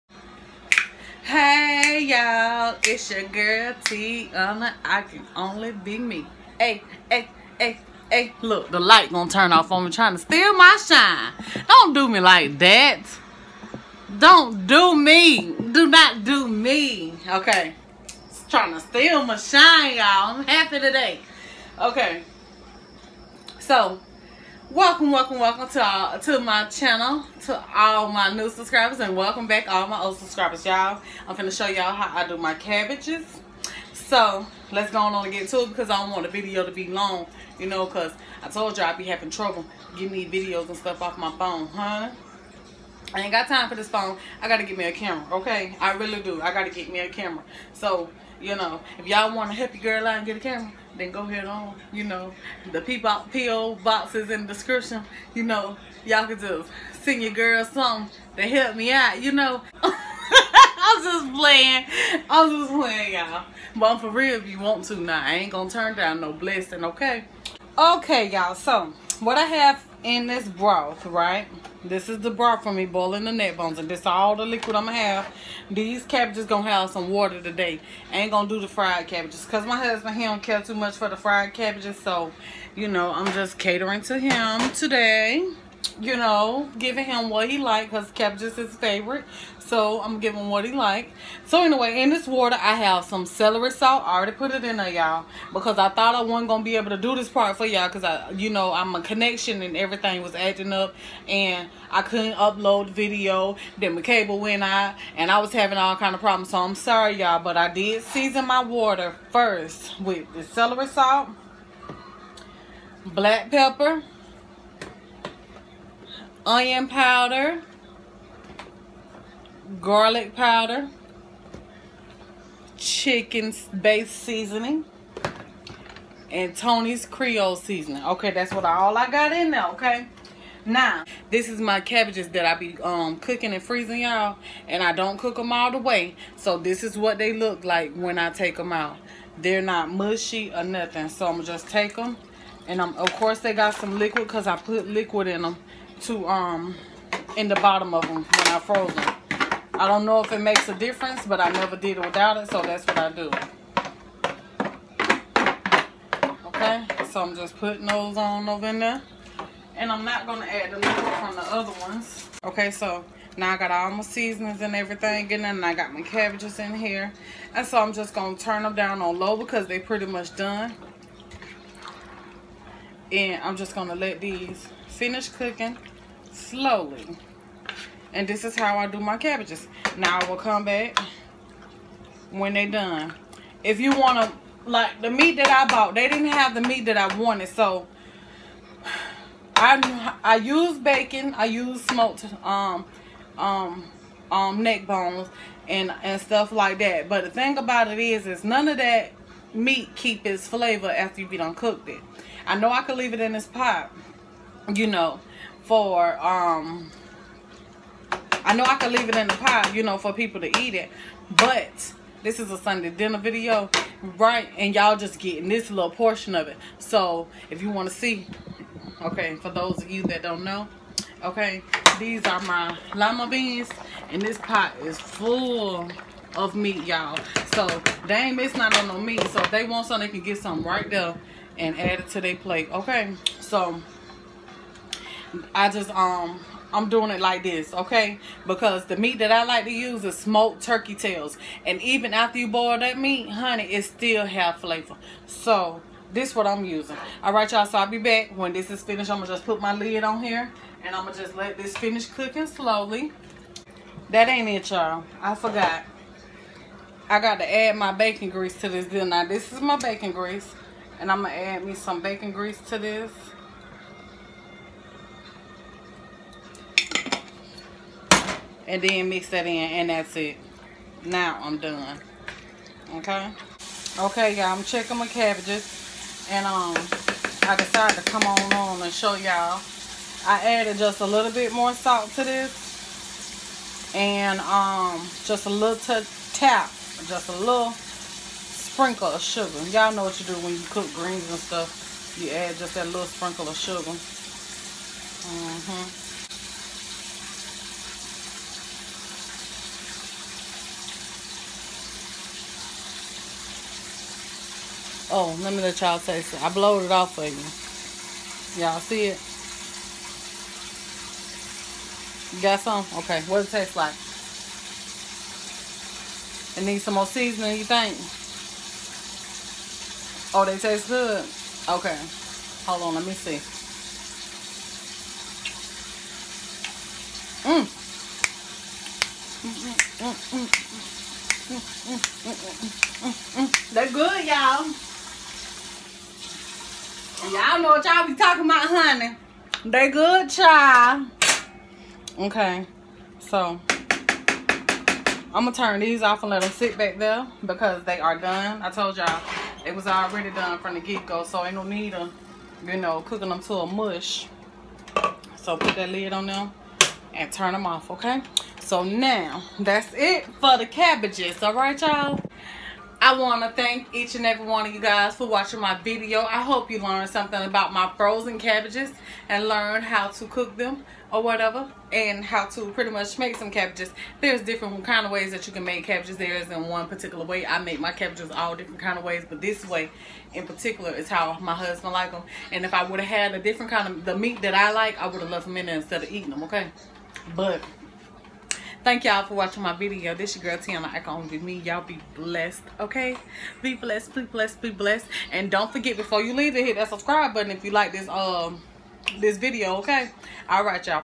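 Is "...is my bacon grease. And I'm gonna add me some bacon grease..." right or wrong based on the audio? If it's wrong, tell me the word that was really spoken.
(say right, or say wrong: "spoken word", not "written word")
right.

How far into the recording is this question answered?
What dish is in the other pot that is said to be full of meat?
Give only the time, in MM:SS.
03:42.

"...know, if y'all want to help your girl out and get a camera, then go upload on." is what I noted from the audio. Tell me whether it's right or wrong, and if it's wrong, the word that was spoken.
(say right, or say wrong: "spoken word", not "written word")
wrong: "ahead", not "upload".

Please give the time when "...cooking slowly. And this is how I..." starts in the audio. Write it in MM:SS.
02:55.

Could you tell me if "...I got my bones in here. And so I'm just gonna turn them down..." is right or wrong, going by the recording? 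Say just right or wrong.
wrong.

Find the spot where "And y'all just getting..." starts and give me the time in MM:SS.
03:34.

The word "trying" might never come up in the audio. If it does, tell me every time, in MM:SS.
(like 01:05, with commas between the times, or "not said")
00:09, 00:18.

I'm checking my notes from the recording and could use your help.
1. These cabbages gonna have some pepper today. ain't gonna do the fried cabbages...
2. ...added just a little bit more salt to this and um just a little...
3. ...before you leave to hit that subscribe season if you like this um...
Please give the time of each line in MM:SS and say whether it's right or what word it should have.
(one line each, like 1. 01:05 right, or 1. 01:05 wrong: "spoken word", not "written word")
1. 01:15 wrong: "water", not "pepper"
2. 04:40 right
3. 06:35 wrong: "button", not "season".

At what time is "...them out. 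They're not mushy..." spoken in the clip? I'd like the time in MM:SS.
02:18.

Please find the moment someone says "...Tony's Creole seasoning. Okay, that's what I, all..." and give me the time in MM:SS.
02:06.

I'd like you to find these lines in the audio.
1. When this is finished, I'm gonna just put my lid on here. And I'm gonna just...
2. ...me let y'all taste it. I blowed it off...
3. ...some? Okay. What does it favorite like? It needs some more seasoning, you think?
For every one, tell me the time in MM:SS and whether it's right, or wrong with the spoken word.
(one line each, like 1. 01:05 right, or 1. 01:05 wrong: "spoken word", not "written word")
1. 04:08 right
2. 05:05 right
3. 05:12 wrong: "taste", not "favorite".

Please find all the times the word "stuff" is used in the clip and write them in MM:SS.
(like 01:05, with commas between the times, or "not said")
00:40, 03:16, 04:51.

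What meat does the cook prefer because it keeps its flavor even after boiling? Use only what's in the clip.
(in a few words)
Smoked turkey tails.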